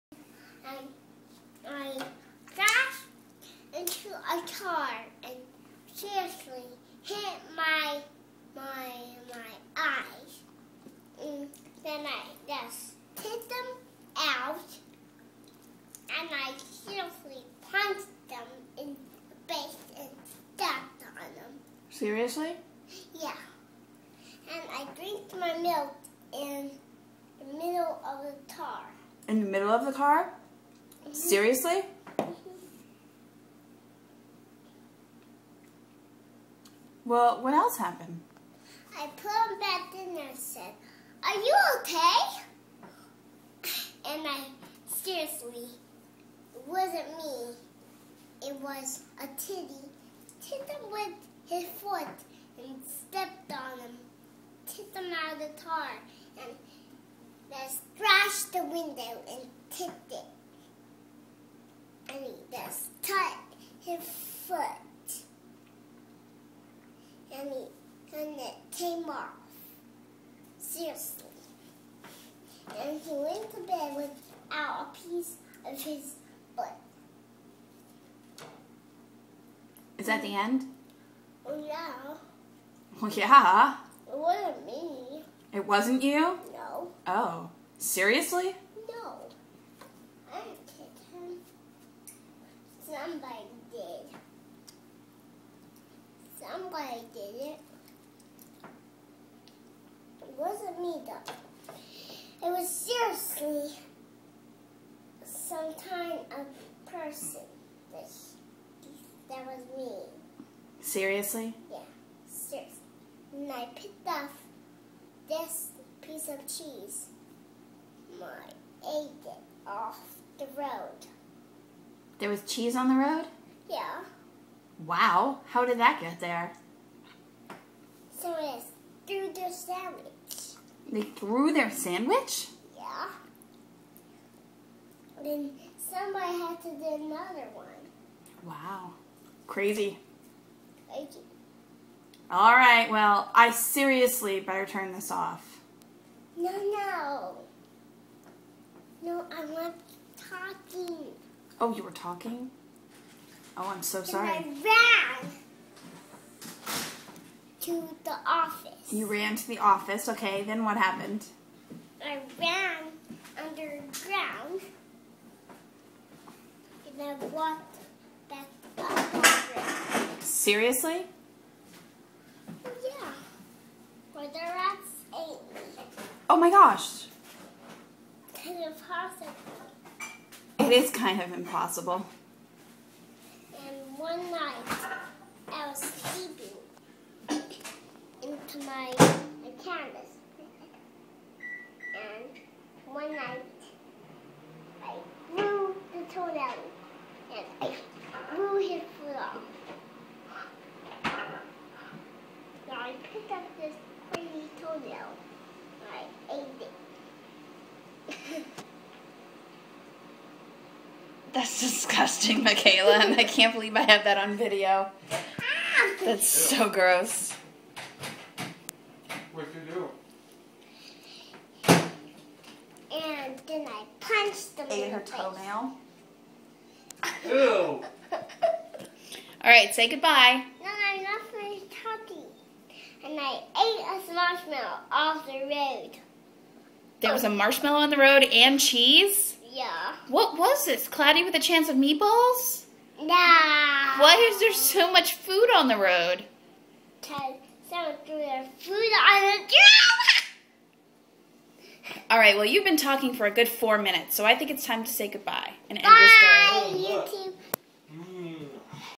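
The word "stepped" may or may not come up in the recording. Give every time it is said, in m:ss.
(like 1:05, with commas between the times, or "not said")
0:20, 0:52.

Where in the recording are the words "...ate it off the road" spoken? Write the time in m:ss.
1:58.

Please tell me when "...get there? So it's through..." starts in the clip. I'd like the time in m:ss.
2:06.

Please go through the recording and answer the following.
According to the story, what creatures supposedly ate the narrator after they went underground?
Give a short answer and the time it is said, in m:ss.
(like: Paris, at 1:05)
rats, at 2:54.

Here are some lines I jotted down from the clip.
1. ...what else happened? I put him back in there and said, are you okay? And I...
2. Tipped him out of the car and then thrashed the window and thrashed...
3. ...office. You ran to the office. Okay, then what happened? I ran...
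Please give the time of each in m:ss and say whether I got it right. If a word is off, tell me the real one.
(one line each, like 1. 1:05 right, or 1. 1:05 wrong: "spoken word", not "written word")
1. 0:37 right
2. 0:54 wrong: "kicked", not "thrashed"
3. 2:38 right.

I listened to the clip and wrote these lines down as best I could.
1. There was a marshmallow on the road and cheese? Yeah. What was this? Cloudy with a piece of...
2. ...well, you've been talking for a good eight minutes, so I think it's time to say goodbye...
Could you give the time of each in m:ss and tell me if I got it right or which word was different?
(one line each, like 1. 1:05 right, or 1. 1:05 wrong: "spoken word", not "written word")
1. 3:57 wrong: "chance", not "piece"
2. 4:12 wrong: "four", not "eight".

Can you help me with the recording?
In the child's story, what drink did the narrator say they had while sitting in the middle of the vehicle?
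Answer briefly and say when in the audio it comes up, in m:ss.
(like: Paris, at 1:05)
milk, at 0:25.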